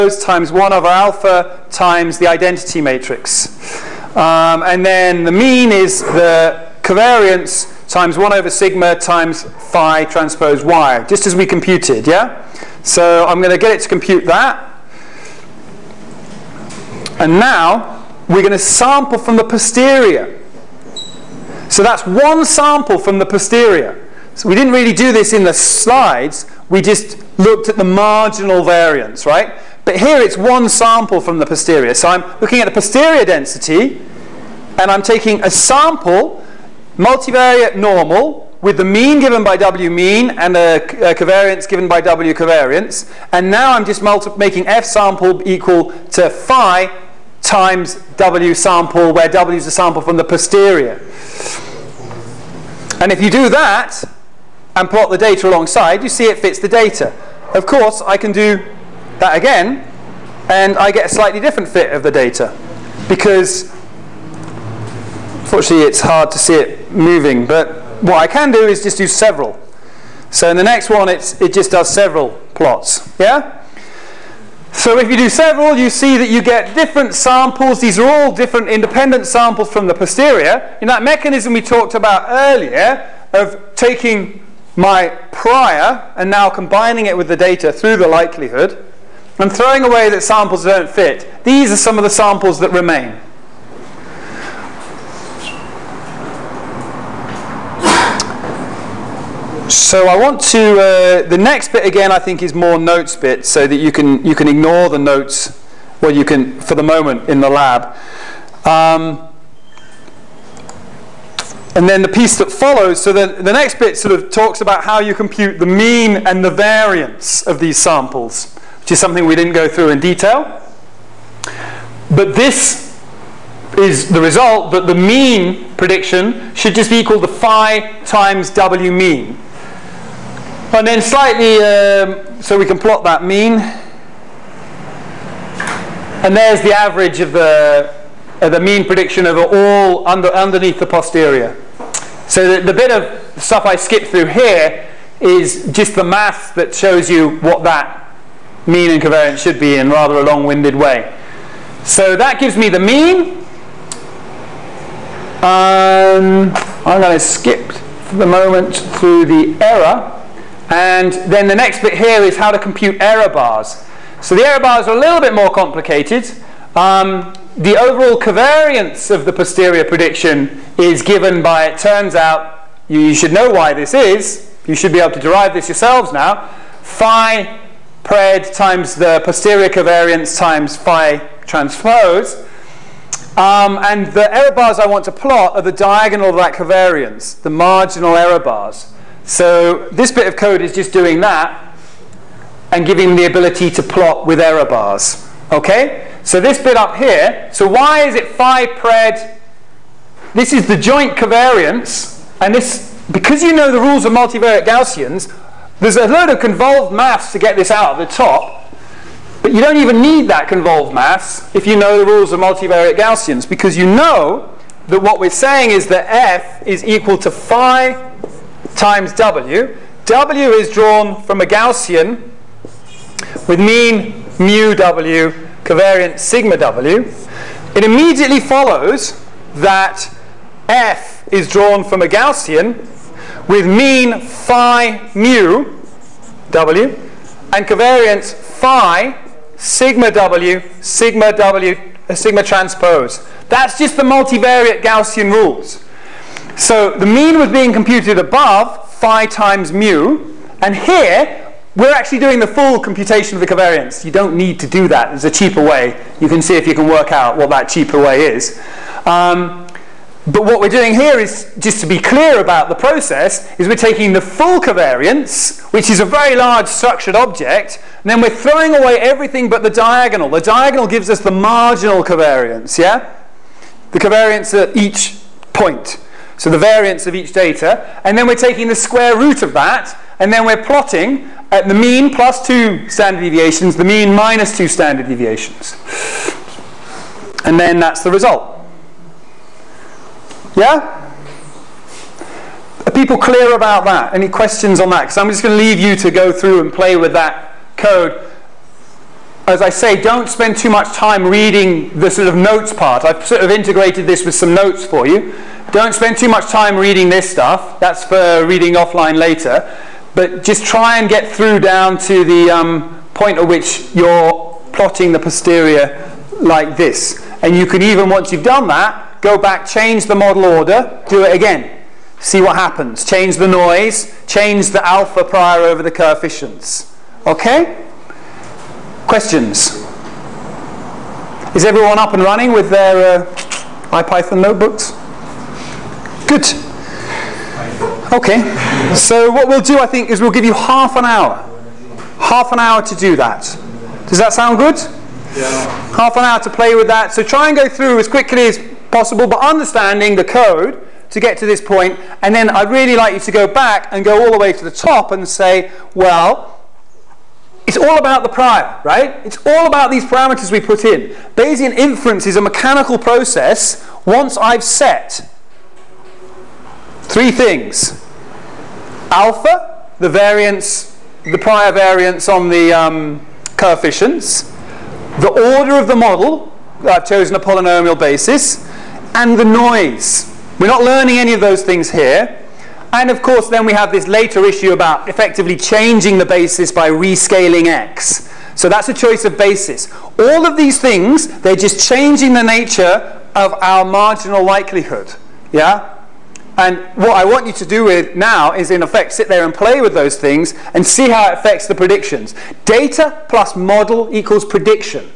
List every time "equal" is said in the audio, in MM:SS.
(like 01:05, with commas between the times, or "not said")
00:45, 02:07, 03:36, 06:44.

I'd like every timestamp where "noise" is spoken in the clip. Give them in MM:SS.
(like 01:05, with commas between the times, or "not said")
05:23, 06:19.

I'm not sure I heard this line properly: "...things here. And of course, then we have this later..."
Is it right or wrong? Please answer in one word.
right.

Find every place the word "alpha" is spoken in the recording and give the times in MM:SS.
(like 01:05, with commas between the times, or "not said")
00:00, 05:24, 06:09.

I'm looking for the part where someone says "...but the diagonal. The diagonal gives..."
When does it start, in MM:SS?
04:29.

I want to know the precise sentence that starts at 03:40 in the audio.
W is drawn from a Gaussian with mean mu W, covariant sigma W.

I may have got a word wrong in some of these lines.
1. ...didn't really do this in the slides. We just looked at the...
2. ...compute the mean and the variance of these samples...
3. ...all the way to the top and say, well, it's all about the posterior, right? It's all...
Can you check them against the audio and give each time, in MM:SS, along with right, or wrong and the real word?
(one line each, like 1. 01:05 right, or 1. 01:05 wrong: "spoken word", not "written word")
1. 00:24 right
2. 01:55 right
3. 05:54 wrong: "prior", not "posterior".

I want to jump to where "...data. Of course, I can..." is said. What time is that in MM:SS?
00:56.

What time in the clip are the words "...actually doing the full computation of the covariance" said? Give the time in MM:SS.
04:11.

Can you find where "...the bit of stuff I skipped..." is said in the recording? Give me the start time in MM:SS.
02:22.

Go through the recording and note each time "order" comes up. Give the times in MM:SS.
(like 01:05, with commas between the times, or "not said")
05:20, 06:15.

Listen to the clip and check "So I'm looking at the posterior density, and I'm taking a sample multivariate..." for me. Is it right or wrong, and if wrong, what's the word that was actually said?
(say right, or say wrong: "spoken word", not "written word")
right.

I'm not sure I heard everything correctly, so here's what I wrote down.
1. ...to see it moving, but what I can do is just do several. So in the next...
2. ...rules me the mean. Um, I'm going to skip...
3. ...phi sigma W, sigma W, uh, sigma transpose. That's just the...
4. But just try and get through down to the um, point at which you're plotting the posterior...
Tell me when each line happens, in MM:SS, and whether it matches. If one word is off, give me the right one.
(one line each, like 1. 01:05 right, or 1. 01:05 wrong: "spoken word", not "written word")
1. 01:06 right
2. 02:32 wrong: "gives", not "rules"
3. 03:58 right
4. 05:10 right.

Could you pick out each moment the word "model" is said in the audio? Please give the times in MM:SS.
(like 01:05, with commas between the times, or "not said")
05:20, 06:15, 06:43.